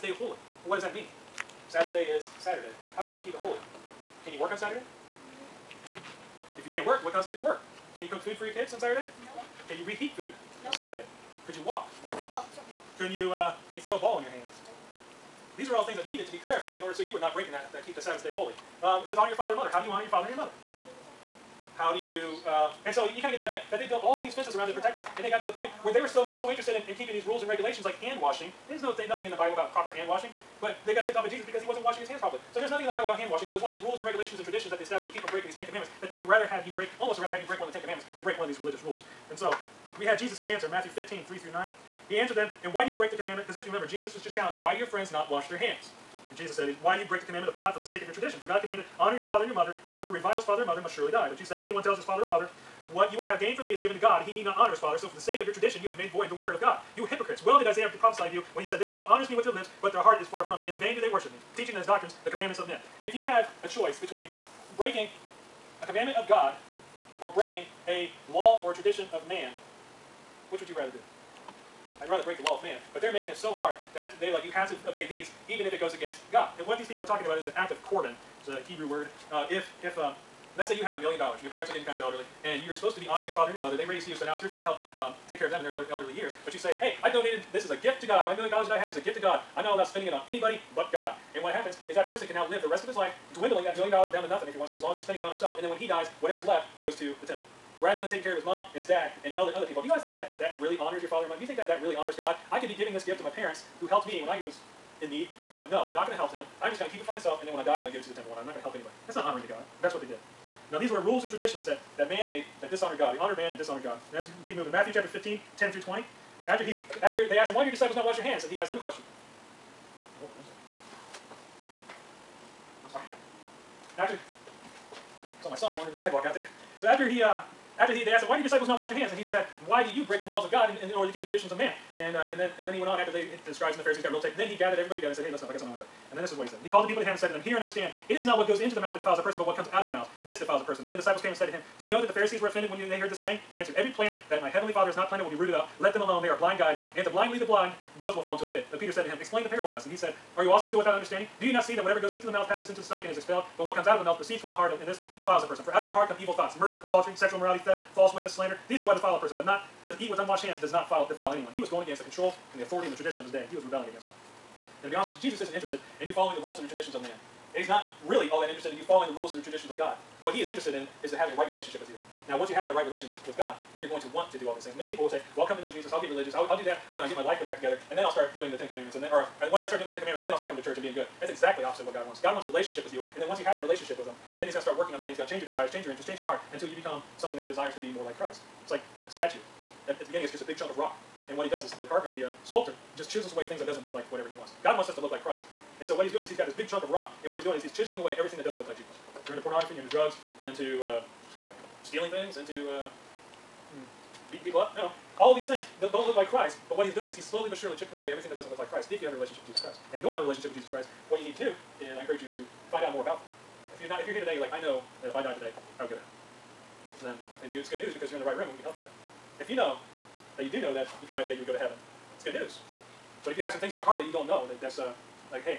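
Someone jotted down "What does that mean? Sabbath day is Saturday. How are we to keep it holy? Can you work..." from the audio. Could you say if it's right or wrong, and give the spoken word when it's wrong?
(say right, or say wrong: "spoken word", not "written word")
right.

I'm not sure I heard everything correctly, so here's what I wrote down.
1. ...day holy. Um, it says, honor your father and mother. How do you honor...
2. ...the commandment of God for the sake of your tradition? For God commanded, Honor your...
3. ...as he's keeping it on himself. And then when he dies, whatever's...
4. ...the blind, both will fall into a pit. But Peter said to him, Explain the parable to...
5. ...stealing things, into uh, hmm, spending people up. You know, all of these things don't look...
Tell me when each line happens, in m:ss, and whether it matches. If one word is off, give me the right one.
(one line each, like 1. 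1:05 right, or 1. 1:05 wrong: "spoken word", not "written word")
1. 0:18 right
2. 0:47 right
3. 1:34 wrong: "spending", not "keeping"
4. 2:27 right
5. 3:21 wrong: "beating", not "spending".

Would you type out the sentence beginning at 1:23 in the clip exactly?
They raised you, so now it's your turn to help um, take care of them in their elder, elderly years.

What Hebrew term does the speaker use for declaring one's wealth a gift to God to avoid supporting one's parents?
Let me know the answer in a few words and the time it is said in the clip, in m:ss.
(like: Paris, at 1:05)
Korban, at 1:17.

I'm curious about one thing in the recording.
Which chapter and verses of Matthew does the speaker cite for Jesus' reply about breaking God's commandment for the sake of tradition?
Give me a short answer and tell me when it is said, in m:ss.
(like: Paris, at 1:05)
Matthew 15:3-9, at 0:40.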